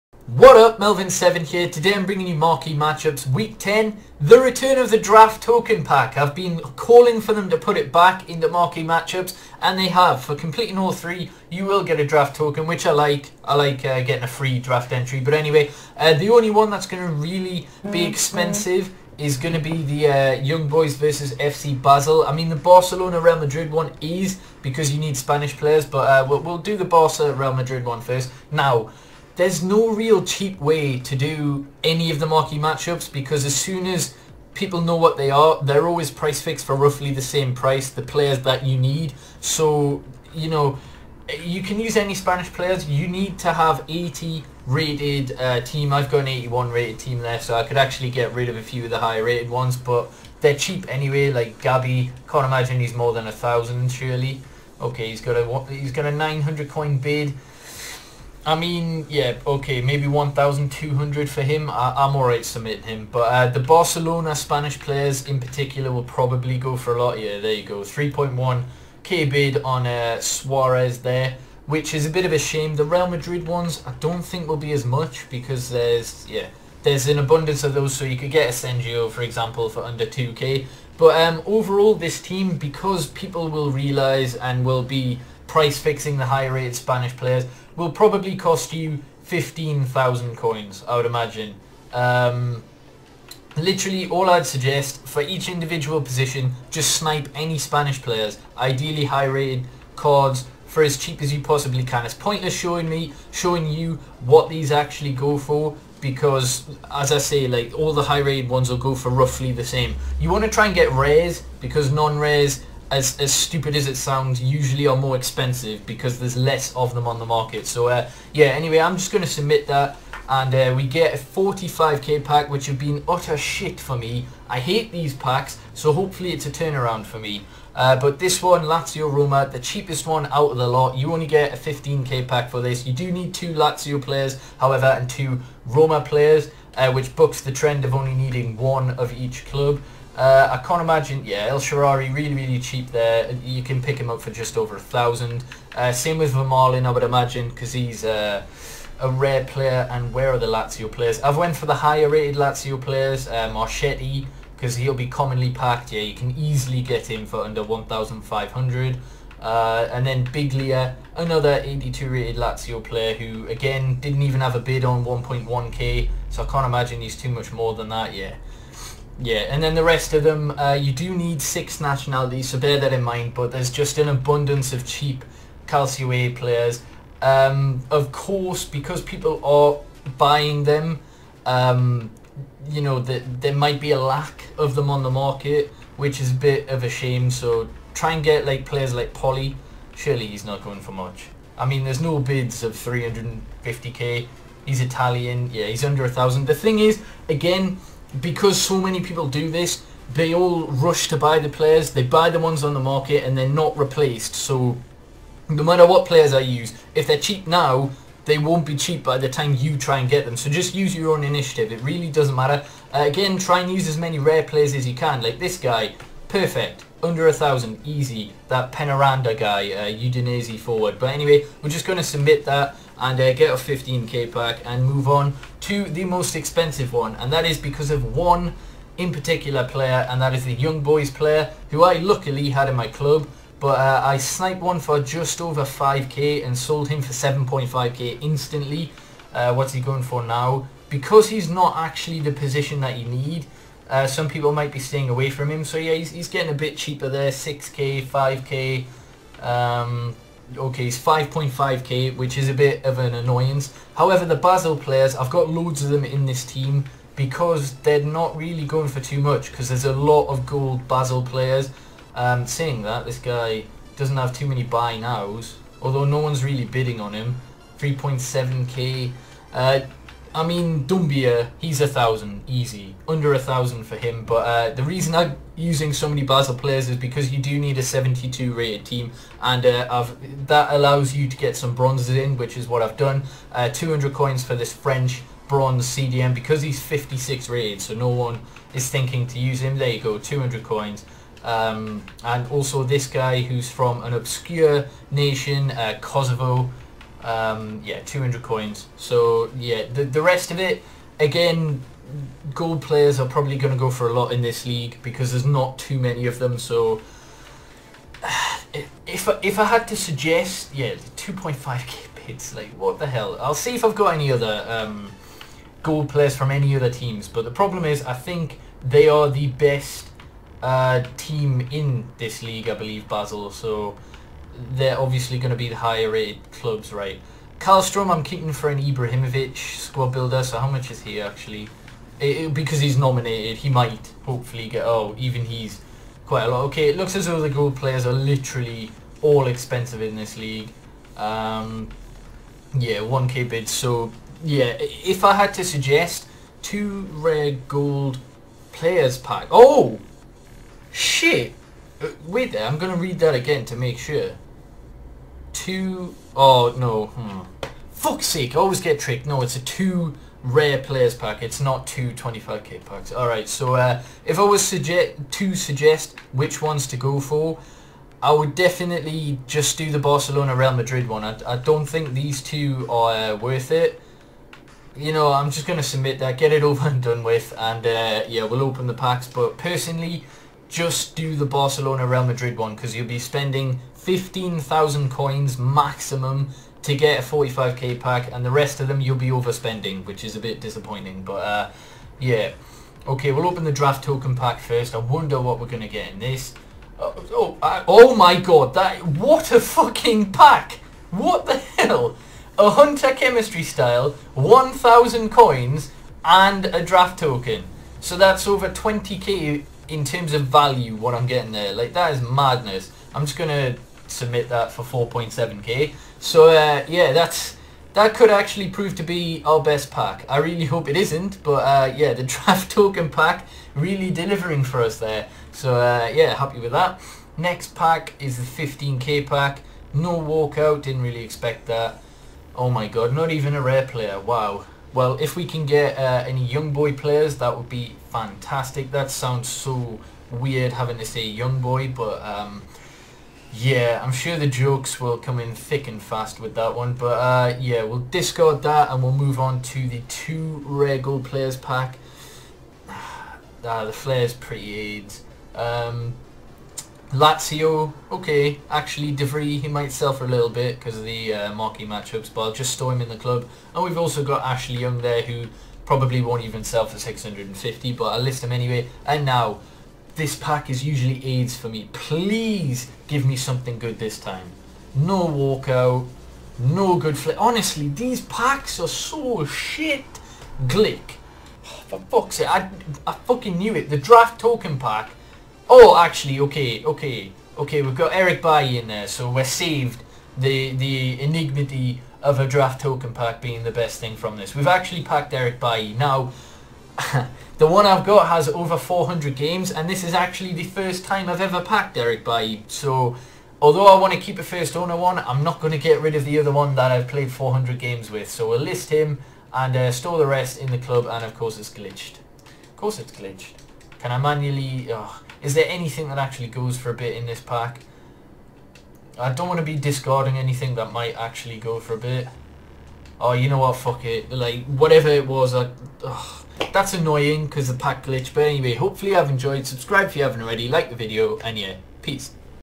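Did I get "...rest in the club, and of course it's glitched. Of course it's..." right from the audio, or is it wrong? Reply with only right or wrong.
right.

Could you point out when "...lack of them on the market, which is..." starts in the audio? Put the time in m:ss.
3:04.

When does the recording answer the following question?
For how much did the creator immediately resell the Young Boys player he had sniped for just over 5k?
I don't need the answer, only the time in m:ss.
3:57.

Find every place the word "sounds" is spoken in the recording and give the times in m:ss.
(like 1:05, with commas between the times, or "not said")
1:53, 7:19.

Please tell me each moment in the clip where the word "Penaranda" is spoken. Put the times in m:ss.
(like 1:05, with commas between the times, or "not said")
3:38.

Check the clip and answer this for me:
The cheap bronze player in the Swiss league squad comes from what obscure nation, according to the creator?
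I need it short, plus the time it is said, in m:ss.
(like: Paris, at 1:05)
Kosovo, at 4:55.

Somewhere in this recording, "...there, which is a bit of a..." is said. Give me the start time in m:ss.
1:11.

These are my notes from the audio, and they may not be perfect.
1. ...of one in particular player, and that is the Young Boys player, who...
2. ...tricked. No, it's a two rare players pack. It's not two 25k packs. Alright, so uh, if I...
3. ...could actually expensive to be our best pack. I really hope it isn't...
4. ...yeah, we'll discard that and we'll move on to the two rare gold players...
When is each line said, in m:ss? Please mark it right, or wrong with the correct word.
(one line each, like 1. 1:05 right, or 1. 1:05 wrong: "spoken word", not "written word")
1. 3:47 right
2. 5:58 right
3. 6:58 wrong: "prove", not "expensive"
4. 7:27 right.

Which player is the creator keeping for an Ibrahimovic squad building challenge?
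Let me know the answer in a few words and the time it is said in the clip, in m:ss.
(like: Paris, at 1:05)
Karlstrom, at 5:27.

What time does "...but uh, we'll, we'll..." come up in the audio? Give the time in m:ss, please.
0:25.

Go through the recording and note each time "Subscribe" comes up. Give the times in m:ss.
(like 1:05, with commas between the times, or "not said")
8:49.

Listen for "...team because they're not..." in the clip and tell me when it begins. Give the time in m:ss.
4:16.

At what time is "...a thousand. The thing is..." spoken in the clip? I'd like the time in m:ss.
3:16.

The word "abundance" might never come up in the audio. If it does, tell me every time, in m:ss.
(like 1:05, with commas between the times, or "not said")
1:17, 2:54.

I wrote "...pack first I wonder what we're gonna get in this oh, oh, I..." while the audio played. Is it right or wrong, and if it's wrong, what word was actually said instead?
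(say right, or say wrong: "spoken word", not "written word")
right.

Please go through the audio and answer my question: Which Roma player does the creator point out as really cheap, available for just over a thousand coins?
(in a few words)
El Shaarawy.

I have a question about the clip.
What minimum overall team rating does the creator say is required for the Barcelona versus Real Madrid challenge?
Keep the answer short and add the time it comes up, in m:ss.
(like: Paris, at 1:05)
80, at 0:43.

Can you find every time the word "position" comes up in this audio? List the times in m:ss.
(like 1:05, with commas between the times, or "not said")
1:36, 4:02.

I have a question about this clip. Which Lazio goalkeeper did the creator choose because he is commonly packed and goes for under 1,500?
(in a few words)
Marchetti.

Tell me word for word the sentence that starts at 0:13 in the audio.
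I like uh, getting a free draft entry.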